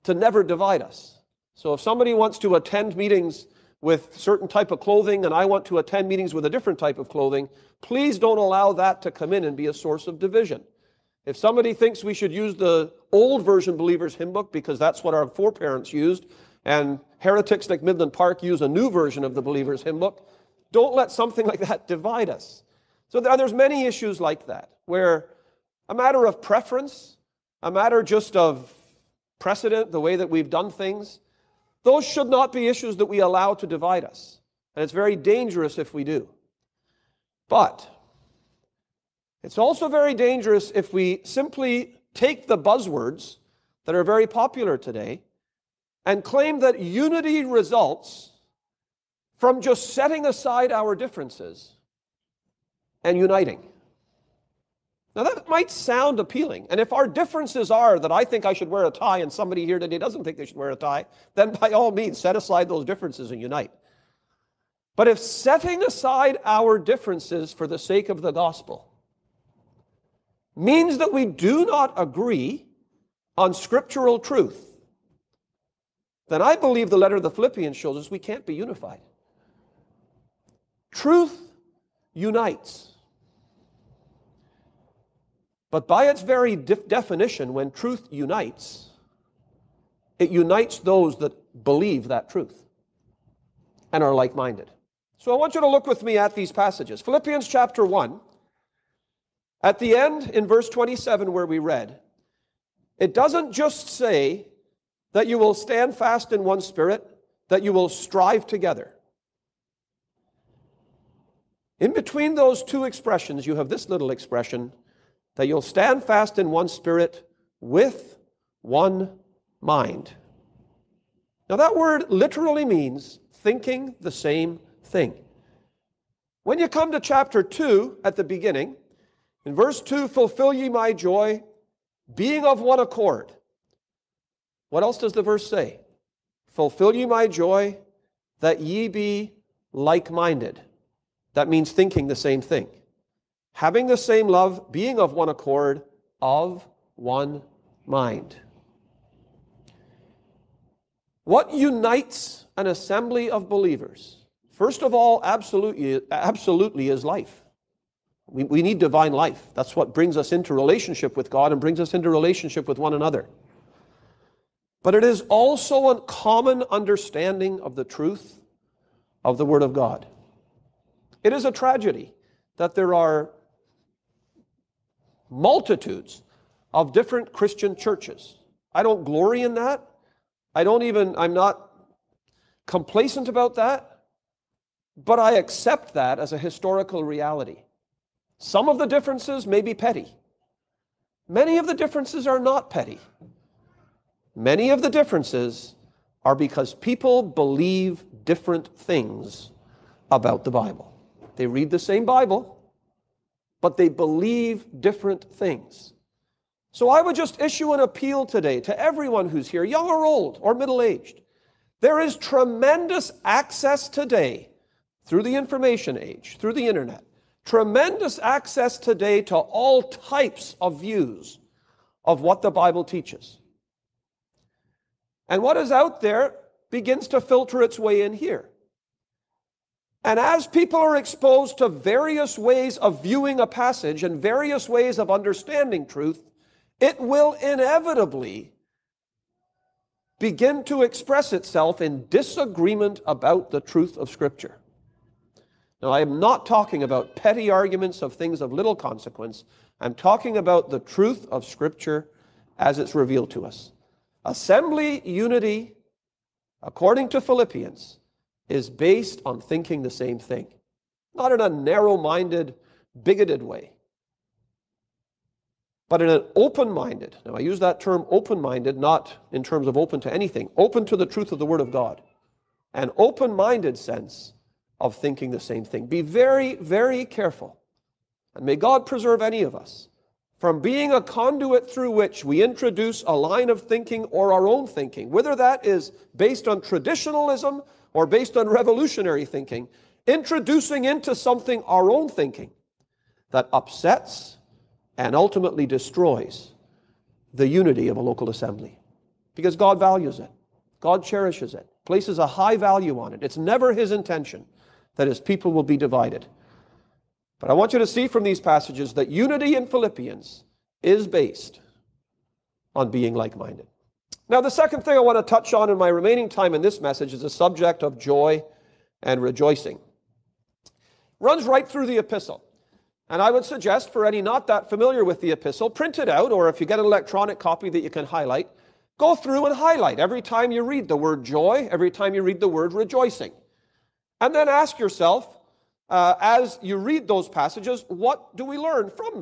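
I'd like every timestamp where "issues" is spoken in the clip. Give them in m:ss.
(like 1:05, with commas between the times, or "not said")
0:23, 0:32, 3:27.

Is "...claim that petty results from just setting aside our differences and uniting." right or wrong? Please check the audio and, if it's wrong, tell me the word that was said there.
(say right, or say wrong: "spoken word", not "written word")
wrong: "unity", not "petty".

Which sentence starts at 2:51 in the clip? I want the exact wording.
It is a tragedy that there are multitudes of different Christian churches.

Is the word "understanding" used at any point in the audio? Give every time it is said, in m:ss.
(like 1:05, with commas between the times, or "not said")
2:46, 3:55.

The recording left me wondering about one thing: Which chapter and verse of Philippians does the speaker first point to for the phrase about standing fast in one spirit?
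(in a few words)
Chapter 1, verse 27.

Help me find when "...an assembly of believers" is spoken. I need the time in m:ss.
2:32.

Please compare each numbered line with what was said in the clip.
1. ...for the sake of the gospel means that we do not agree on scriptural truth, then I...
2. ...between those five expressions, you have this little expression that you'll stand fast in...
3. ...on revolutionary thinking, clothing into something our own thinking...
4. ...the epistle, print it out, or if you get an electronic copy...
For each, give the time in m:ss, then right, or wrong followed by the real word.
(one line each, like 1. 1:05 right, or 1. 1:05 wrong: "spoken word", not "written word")
1. 1:07 right
2. 1:51 wrong: "two", not "five"
3. 4:48 wrong: "introducing", not "clothing"
4. 5:25 right.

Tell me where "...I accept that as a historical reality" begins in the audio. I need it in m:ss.
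3:05.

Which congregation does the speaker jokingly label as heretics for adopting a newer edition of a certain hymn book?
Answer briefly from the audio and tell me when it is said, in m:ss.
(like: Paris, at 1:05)
Midland Park, at 0:17.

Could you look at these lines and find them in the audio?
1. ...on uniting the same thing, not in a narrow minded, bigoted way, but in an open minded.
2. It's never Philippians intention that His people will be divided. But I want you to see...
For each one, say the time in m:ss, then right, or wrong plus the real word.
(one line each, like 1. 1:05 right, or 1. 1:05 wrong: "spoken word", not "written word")
1. 4:19 wrong: "thinking", not "uniting"
2. 5:03 wrong: "His", not "Philippians".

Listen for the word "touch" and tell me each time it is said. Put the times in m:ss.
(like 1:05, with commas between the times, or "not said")
5:15.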